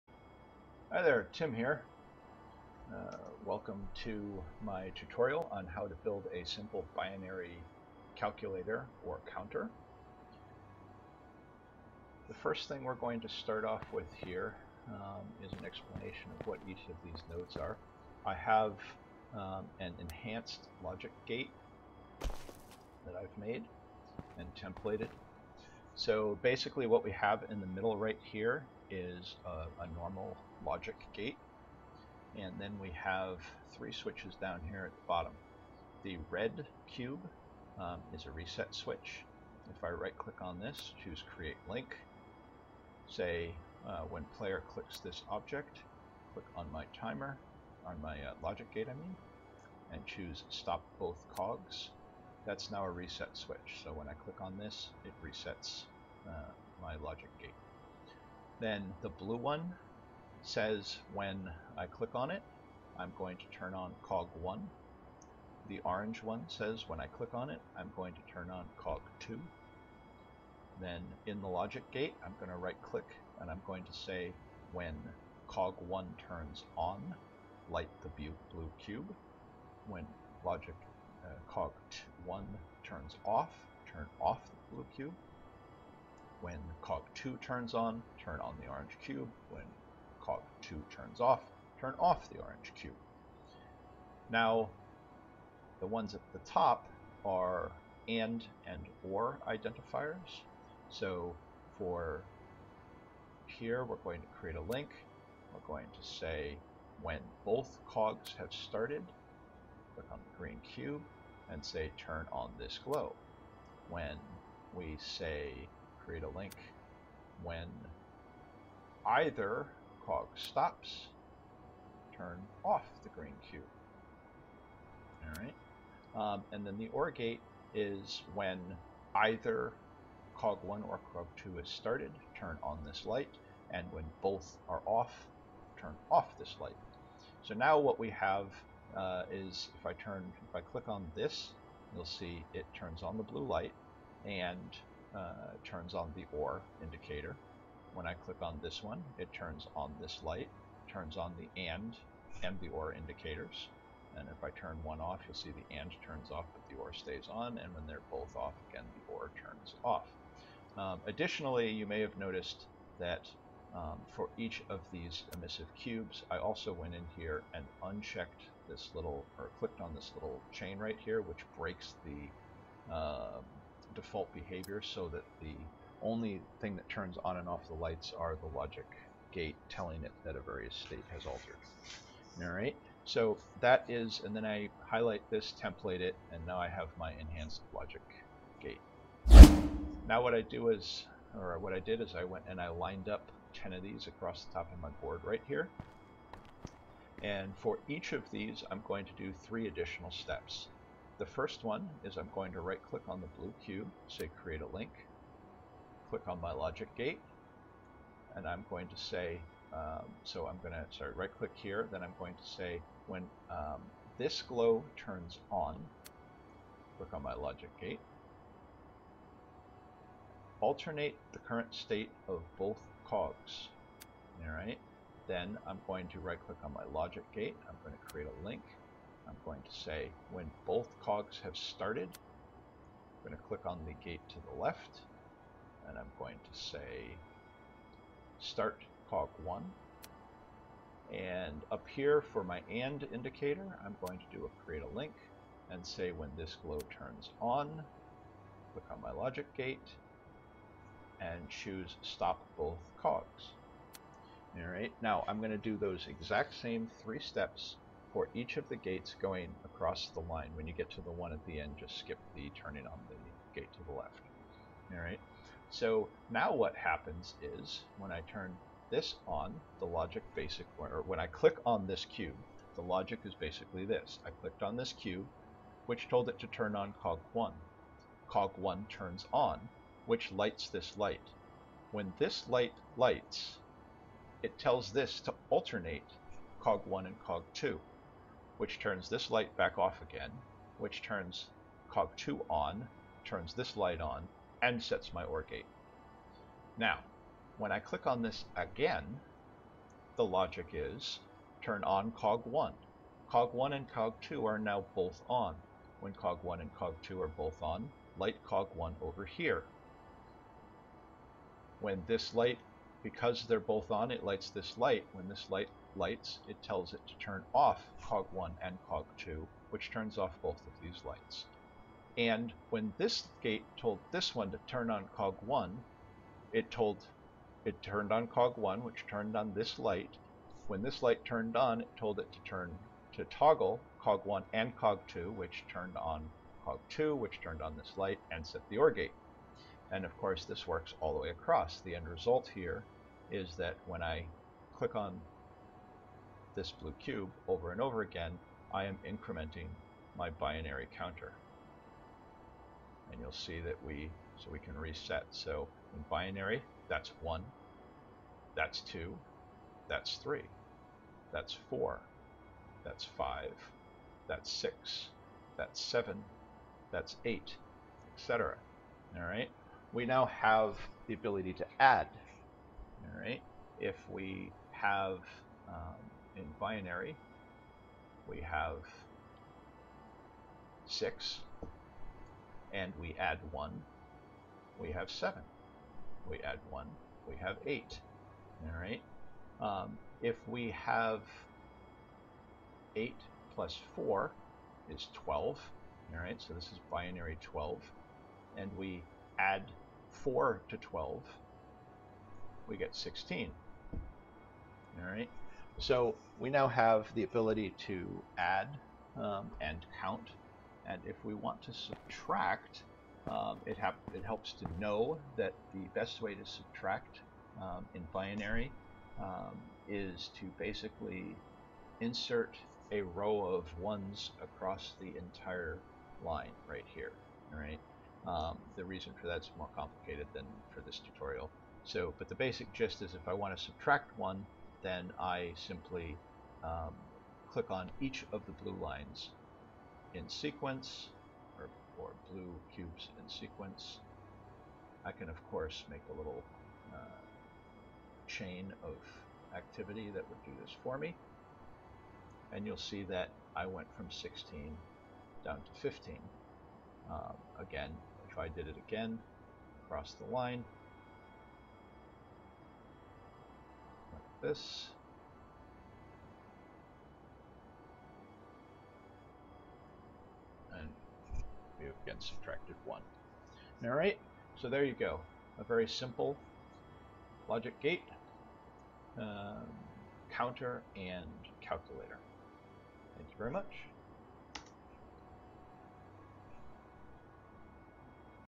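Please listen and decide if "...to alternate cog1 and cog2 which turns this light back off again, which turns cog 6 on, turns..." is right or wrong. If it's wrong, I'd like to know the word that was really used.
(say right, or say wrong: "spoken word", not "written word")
wrong: "2", not "6".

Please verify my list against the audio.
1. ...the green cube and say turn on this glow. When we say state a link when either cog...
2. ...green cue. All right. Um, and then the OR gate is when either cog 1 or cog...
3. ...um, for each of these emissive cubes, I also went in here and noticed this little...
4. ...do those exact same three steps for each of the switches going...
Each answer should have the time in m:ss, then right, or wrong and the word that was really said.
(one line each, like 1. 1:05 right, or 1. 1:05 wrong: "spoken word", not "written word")
1. 1:50 wrong: "create", not "state"
2. 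2:03 right
3. 2:43 wrong: "unchecked", not "noticed"
4. 4:15 wrong: "gates", not "switches".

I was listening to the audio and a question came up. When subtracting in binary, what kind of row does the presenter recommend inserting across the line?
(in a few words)
A row of ones.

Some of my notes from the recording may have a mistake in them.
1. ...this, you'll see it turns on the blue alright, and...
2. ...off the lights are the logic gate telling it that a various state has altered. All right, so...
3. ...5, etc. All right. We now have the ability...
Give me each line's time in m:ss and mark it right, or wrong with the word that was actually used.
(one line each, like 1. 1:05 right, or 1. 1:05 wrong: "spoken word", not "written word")
1. 2:21 wrong: "light", not "alright"
2. 2:57 right
3. 6:07 wrong: "8", not "5".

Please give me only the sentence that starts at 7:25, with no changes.
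I can, of course, make a little uh, chain of activity that would do this for me.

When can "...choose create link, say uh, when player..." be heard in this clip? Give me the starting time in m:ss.
0:41.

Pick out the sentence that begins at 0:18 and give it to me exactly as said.
I have um, an enhanced logic gate that I've made and templated.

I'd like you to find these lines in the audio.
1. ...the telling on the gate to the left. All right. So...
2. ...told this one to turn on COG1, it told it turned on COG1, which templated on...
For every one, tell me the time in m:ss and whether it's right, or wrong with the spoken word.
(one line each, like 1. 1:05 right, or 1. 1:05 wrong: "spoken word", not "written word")
1. 4:22 wrong: "turning", not "telling"
2. 5:23 wrong: "turned", not "templated".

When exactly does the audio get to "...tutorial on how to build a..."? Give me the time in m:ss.
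0:04.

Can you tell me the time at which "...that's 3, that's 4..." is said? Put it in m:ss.
5:59.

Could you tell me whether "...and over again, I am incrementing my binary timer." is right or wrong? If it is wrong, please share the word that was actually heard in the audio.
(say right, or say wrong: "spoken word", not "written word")
wrong: "counter", not "timer".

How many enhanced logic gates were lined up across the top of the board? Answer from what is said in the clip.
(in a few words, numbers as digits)
10.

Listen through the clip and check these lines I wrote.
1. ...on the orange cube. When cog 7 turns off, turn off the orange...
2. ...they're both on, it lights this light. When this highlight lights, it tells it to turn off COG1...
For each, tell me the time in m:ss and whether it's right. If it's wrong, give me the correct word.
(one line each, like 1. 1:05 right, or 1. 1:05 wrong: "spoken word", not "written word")
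1. 1:28 wrong: "2", not "7"
2. 5:13 wrong: "light", not "highlight".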